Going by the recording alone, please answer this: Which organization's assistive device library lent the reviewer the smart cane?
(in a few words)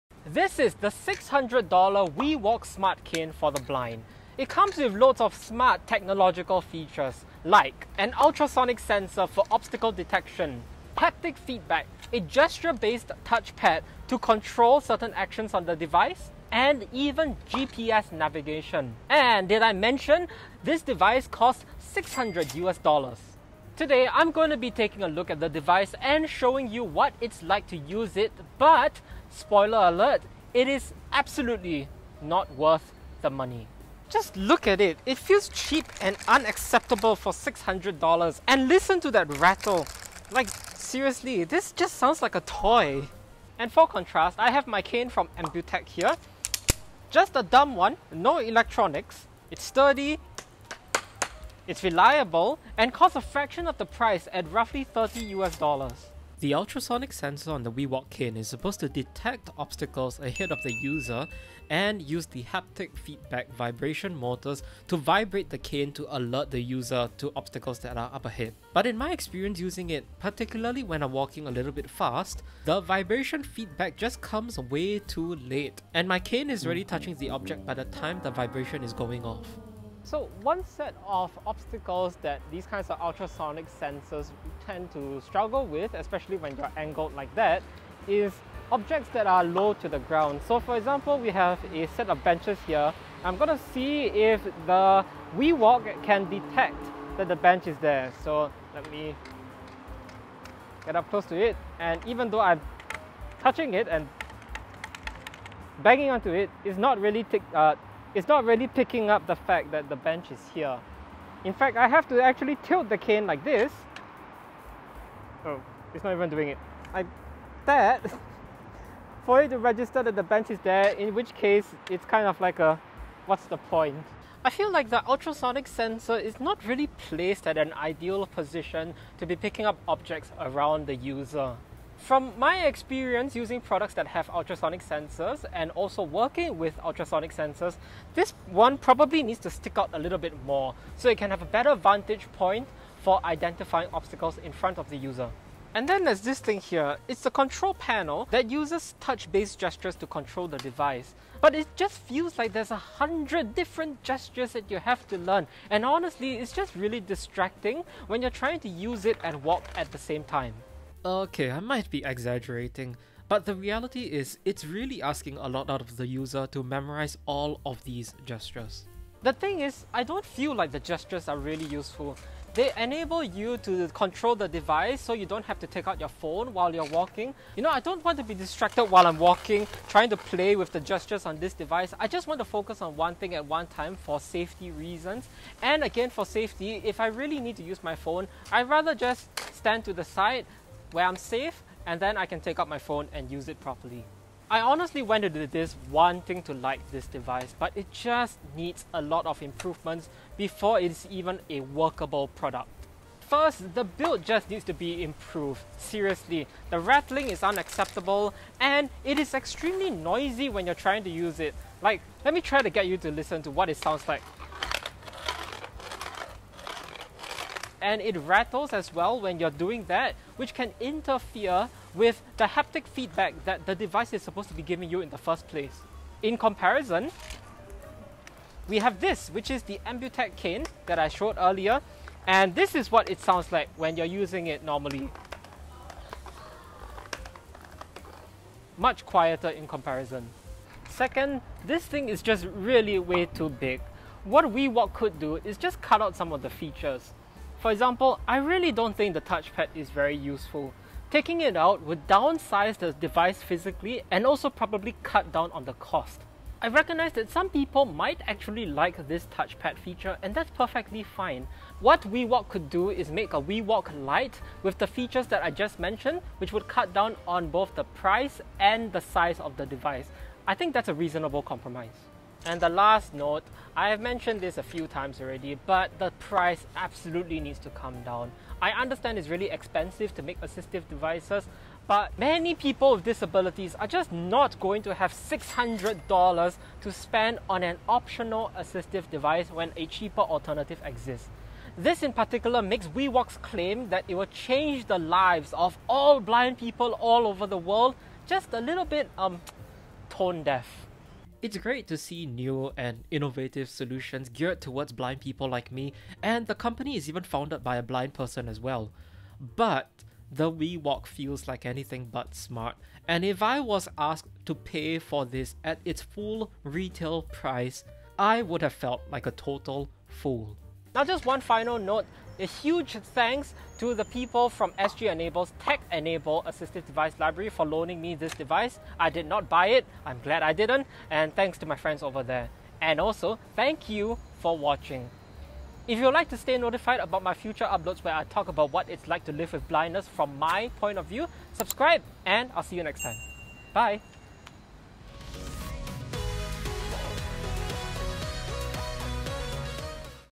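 SG Enable.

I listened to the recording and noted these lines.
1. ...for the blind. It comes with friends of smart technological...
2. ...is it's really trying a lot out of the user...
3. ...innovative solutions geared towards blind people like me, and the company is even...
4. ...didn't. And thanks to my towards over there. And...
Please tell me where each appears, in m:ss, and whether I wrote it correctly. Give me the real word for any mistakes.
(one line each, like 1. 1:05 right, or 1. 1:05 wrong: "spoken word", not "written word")
1. 0:03 wrong: "loads", not "friends"
2. 2:44 wrong: "asking", not "trying"
3. 5:03 right
4. 5:30 wrong: "friends", not "towards".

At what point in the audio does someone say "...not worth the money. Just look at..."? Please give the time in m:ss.
0:32.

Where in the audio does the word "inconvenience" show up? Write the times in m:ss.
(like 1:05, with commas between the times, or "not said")
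not said.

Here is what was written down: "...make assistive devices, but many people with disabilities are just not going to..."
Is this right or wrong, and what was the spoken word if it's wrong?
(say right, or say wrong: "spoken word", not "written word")
right.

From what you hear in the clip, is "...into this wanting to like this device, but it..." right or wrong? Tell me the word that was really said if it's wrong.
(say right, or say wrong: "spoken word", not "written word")
right.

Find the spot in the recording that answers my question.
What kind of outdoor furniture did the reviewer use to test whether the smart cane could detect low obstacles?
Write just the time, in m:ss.
1:32.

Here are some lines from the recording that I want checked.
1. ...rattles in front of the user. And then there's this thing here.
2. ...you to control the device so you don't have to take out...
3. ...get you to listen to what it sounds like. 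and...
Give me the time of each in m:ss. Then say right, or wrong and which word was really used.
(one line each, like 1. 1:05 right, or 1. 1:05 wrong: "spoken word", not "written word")
1. 2:23 wrong: "obstacles", not "rattles"
2. 2:53 right
3. 3:32 right.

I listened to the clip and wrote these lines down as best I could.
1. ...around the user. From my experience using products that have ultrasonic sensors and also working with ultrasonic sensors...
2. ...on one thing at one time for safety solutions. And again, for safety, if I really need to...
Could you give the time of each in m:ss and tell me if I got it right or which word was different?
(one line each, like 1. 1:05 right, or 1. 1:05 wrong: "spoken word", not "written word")
1. 2:10 right
2. 3:02 wrong: "reasons", not "solutions".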